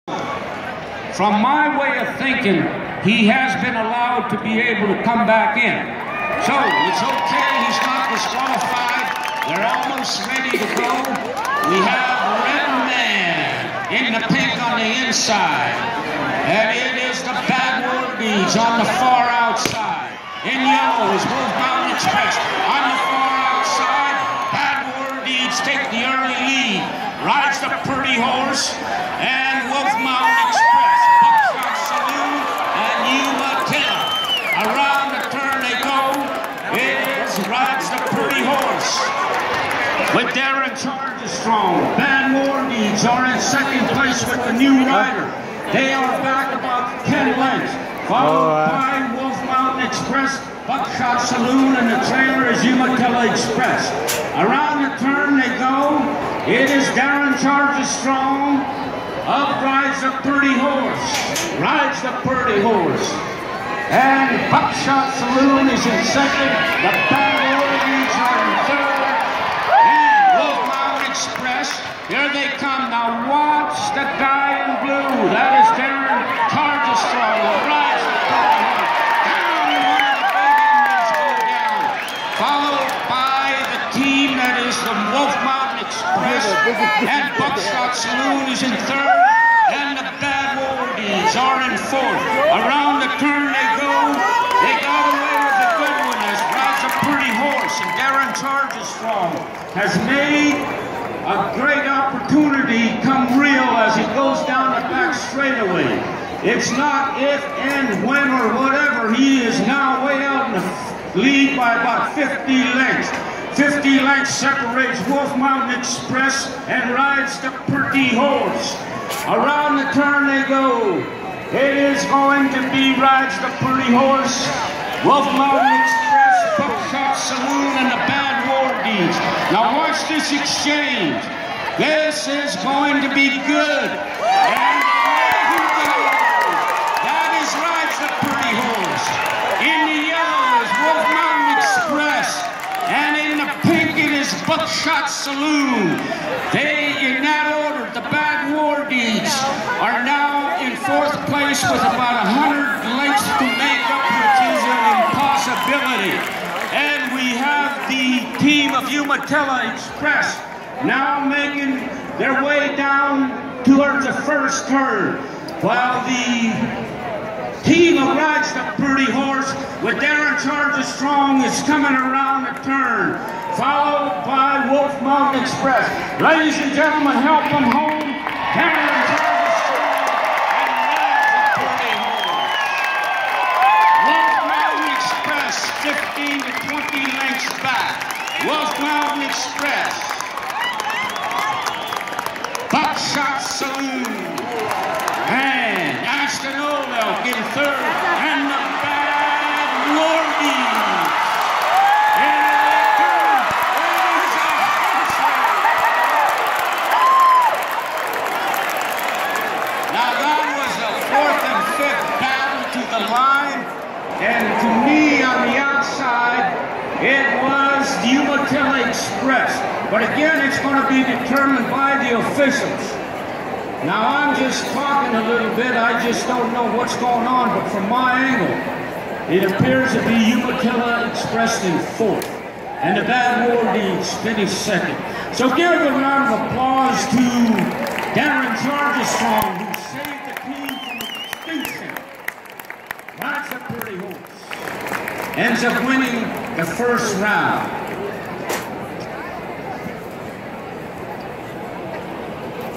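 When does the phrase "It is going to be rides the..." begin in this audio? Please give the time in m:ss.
2:01.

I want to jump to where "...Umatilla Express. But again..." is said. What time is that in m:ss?
3:38.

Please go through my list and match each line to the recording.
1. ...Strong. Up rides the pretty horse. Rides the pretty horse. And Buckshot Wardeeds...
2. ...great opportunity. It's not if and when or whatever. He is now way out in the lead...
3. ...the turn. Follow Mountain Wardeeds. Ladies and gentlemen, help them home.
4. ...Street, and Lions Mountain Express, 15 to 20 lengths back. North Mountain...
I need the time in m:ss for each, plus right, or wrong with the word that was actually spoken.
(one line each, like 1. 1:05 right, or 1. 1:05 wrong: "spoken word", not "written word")
1. 0:57 wrong: "Saloon", not "Wardeeds"
2. 1:41 right
3. 2:52 wrong: "Express", not "Wardeeds"
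4. 3:01 right.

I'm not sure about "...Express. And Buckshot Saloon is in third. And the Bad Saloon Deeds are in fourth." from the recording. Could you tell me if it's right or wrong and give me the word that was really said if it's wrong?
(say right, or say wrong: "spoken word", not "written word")
wrong: "War", not "Saloon".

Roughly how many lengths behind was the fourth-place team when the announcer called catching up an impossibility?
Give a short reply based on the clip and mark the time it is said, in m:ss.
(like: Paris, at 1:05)
100, at 2:32.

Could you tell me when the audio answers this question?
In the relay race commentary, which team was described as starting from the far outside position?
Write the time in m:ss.
0:17.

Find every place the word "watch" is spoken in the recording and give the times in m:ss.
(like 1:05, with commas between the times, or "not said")
1:13, 2:09.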